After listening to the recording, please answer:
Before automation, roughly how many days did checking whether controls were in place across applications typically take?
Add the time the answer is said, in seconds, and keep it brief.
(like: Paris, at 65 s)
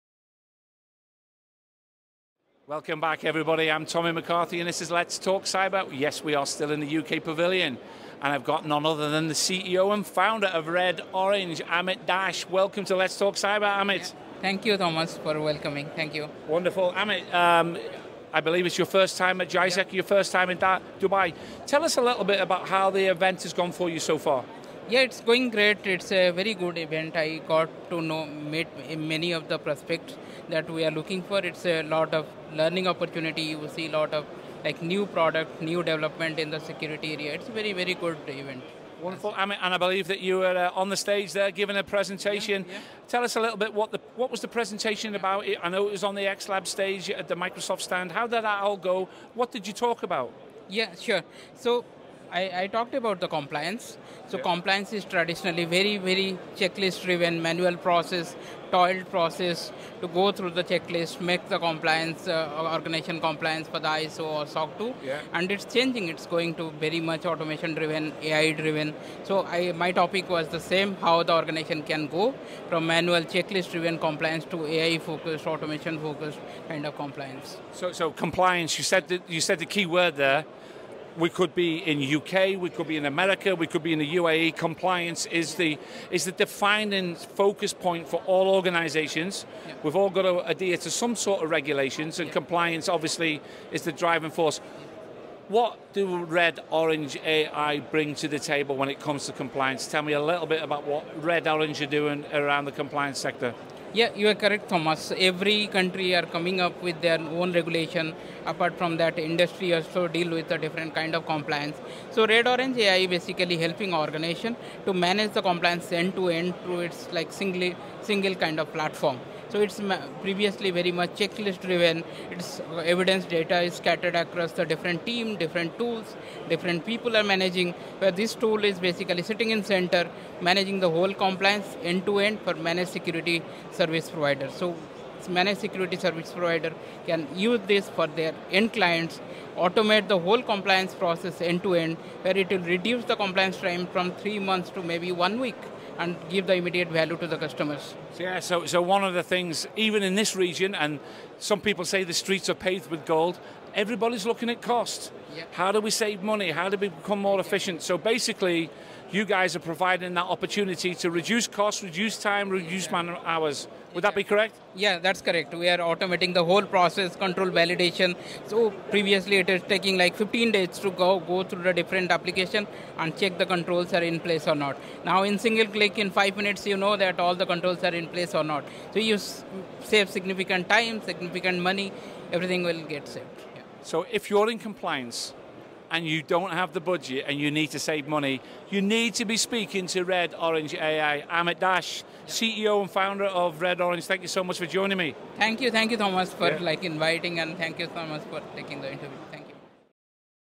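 15 days, at 170 s.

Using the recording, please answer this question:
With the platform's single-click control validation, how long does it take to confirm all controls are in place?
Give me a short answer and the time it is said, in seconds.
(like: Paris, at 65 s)
5 minutes, at 176 s.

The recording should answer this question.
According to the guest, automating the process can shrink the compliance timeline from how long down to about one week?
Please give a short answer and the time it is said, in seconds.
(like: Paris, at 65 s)
3 months, at 144 s.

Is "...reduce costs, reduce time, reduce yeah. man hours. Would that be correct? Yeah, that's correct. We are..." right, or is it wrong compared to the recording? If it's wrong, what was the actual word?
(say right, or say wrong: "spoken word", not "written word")
right.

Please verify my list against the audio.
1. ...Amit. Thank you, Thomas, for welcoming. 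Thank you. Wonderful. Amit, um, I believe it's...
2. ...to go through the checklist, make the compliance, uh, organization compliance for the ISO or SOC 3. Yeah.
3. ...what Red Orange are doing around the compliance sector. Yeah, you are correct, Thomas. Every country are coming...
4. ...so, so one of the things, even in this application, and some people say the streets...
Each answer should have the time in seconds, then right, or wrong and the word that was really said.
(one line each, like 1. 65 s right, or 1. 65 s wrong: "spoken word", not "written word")
1. 13 s right
2. 59 s wrong: "2", not "3"
3. 100 s right
4. 148 s wrong: "region", not "application".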